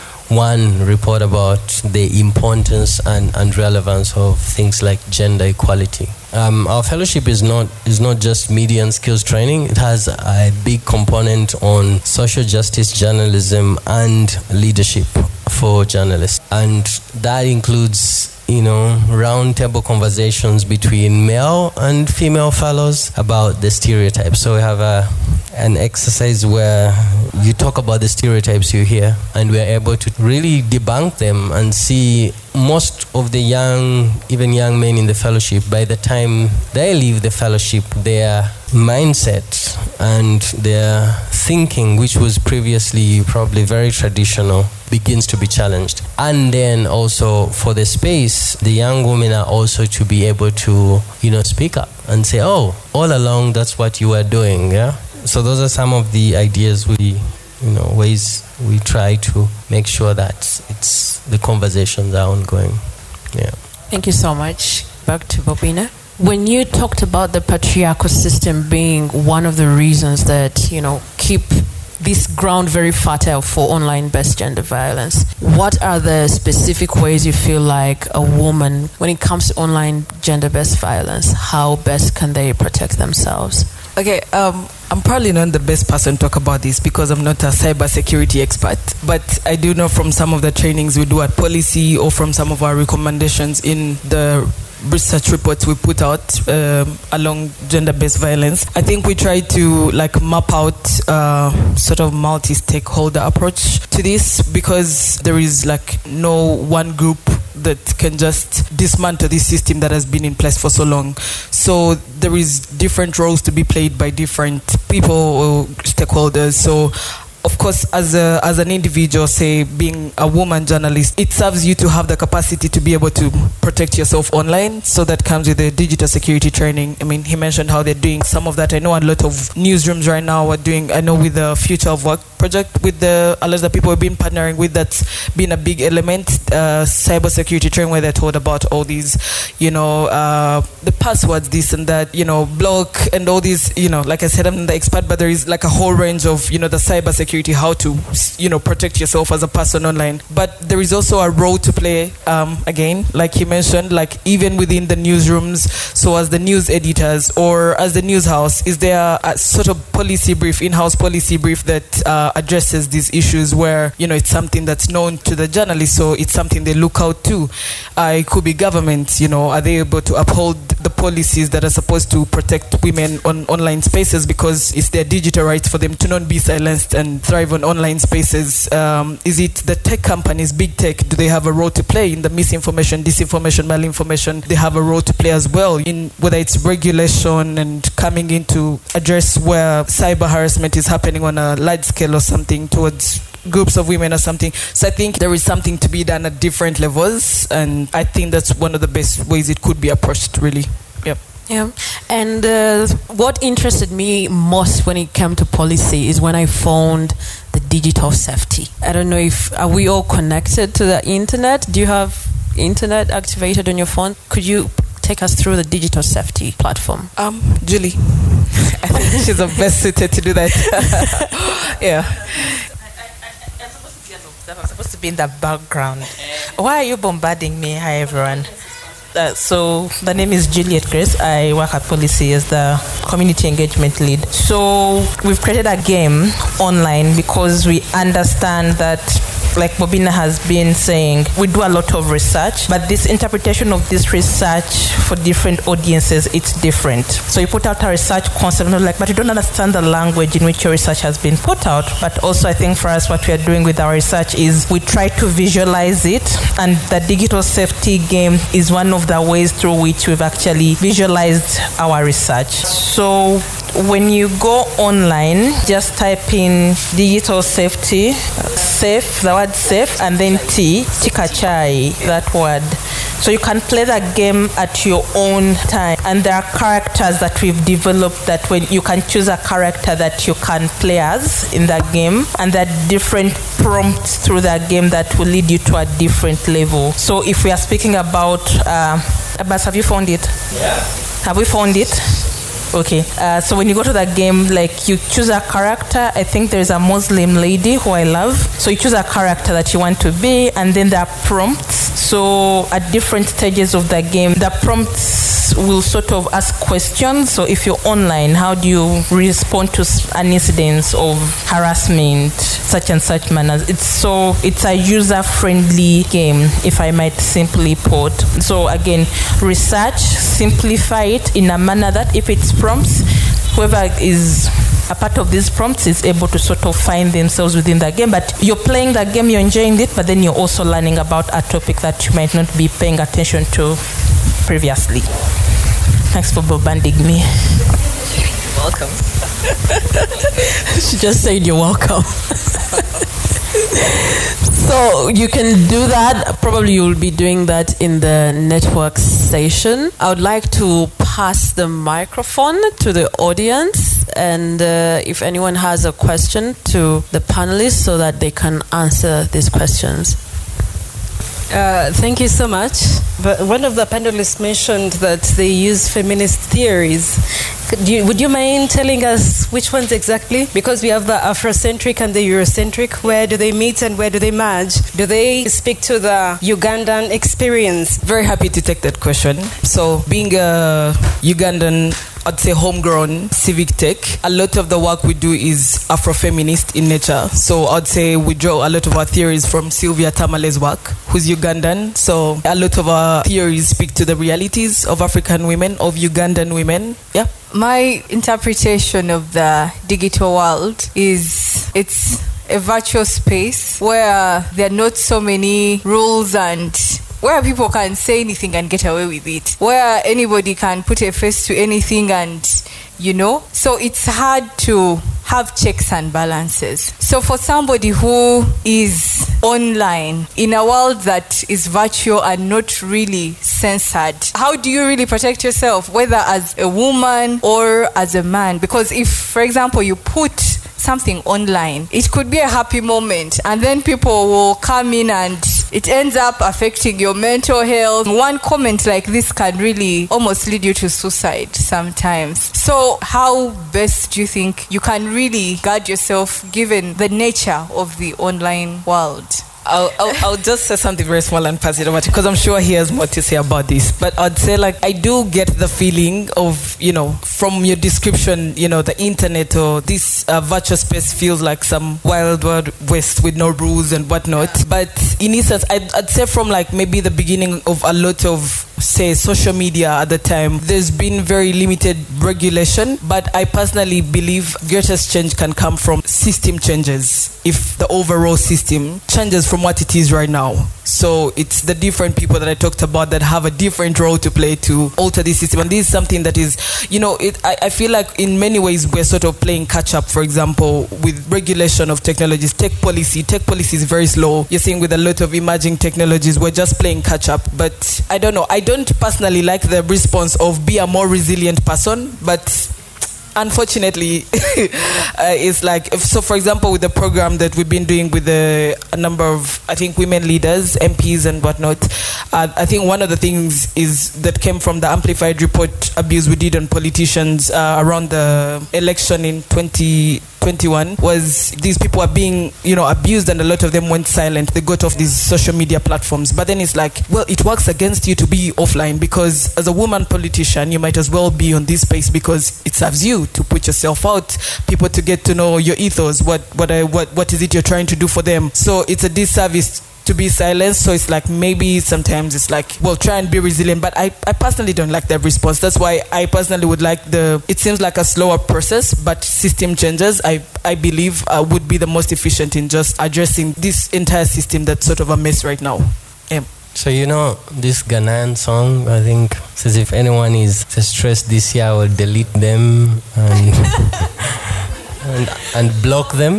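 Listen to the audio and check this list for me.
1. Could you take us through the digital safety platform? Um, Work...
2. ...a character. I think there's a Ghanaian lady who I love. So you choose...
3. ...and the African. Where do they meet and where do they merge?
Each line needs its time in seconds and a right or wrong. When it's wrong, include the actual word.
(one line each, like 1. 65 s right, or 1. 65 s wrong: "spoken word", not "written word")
1. 214 s wrong: "Julie", not "Work"
2. 295 s wrong: "Muslim", not "Ghanaian"
3. 372 s wrong: "Eurocentric", not "African".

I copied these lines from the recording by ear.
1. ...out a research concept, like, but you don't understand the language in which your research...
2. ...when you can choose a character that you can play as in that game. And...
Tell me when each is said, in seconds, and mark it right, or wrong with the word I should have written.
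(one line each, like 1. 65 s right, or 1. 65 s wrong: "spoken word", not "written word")
1. 247 s right
2. 278 s right.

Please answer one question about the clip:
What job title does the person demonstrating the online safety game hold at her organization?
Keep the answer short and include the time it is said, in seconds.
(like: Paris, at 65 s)
Community engagement lead, at 233 s.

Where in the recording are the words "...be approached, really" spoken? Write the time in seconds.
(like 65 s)
199 s.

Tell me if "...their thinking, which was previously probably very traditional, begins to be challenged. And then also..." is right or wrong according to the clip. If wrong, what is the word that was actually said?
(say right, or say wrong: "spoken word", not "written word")
right.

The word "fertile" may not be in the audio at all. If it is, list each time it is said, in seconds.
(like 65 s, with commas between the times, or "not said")
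72 s.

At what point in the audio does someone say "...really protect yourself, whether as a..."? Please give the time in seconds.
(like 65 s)
424 s.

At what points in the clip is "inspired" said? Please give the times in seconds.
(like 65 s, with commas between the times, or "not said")
not said.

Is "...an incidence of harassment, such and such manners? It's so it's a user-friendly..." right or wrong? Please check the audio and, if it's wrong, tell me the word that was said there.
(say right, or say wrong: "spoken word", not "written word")
right.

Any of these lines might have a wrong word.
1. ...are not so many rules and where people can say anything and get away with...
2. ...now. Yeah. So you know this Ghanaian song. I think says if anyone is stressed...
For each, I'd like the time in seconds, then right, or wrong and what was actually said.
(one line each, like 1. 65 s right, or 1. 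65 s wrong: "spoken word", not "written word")
1. 404 s right
2. 555 s right.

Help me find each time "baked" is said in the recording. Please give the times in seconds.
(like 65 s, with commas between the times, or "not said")
not said.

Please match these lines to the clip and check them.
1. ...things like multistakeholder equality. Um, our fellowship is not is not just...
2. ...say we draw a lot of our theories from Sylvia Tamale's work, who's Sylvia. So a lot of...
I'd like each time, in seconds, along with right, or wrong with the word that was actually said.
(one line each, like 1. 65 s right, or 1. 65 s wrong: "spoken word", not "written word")
1. 4 s wrong: "gender", not "multistakeholder"
2. 387 s wrong: "Ugandan", not "Sylvia".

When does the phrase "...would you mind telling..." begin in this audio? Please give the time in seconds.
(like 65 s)
368 s.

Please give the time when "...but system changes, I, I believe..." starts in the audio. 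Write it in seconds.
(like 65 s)
548 s.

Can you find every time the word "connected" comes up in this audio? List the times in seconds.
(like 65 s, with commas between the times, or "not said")
210 s.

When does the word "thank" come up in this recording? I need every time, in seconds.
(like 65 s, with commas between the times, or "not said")
63 s, 336 s, 361 s.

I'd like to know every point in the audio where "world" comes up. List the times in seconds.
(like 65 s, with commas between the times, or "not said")
400 s, 420 s, 448 s.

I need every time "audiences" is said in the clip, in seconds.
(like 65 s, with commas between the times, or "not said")
245 s, 353 s.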